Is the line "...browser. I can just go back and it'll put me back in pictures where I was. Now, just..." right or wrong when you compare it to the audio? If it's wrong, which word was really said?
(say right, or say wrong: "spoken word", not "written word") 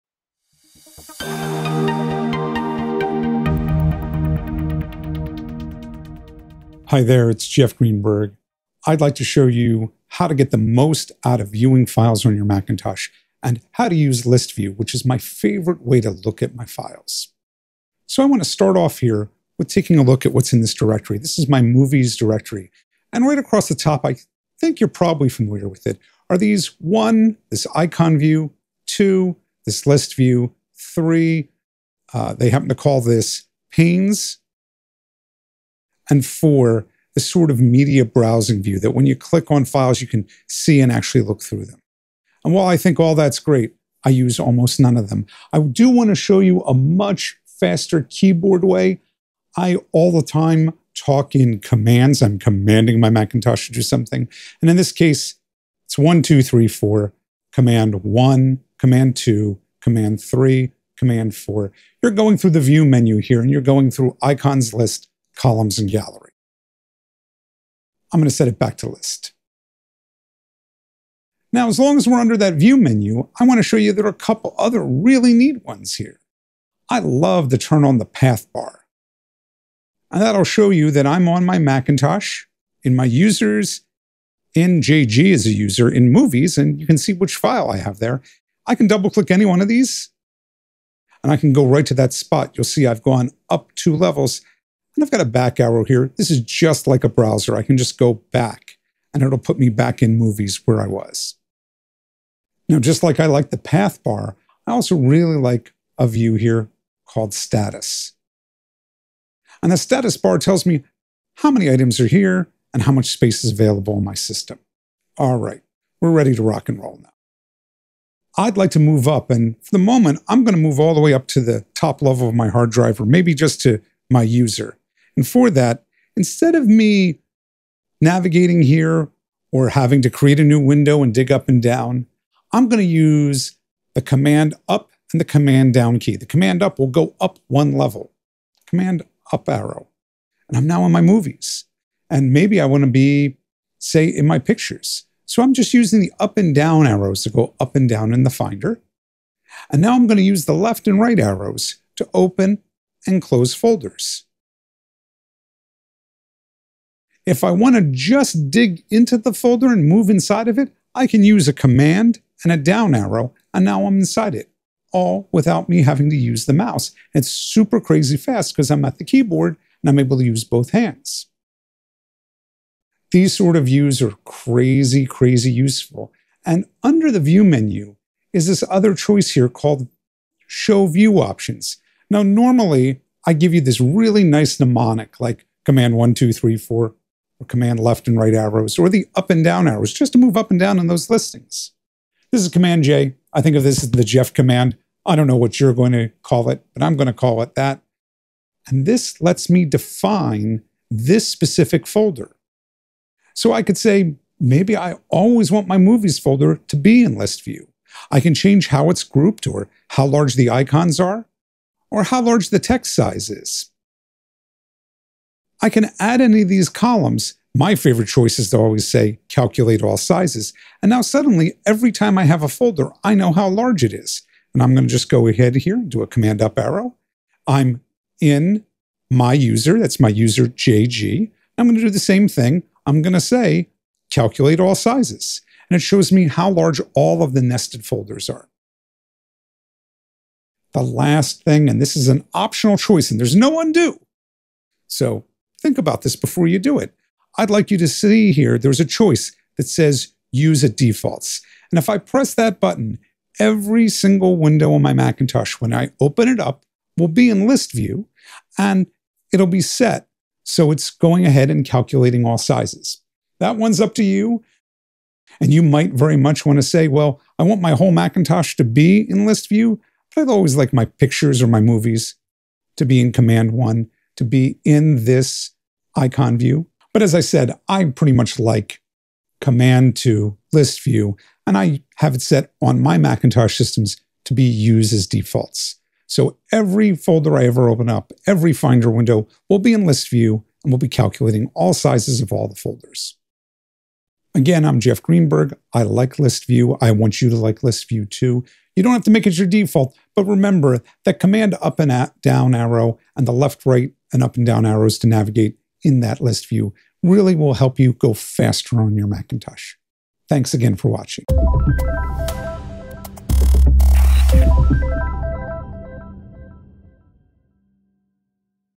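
wrong: "movies", not "pictures".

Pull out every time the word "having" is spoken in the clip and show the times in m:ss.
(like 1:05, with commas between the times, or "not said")
2:09, 2:45.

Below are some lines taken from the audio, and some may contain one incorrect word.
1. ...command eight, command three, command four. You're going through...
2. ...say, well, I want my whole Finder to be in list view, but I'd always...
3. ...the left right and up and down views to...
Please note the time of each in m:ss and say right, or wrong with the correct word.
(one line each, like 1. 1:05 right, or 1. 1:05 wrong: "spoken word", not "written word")
1. 0:58 wrong: "two", not "eight"
2. 4:26 wrong: "Macintosh", not "Finder"
3. 5:03 wrong: "arrows", not "views".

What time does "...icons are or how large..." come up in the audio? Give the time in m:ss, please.
3:30.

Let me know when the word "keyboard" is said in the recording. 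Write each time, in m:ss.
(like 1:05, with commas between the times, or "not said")
0:48, 2:49.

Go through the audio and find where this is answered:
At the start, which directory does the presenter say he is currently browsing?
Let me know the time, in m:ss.
0:21.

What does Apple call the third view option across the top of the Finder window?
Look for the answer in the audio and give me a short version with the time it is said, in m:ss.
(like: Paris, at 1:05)
panes, at 0:33.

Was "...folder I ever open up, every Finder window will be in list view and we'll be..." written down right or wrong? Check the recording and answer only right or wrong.
right.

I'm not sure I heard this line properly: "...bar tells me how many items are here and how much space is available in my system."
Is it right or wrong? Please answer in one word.
right.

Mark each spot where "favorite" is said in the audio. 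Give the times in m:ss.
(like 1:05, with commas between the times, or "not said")
0:15, 3:37.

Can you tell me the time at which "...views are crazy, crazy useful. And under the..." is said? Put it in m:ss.
2:53.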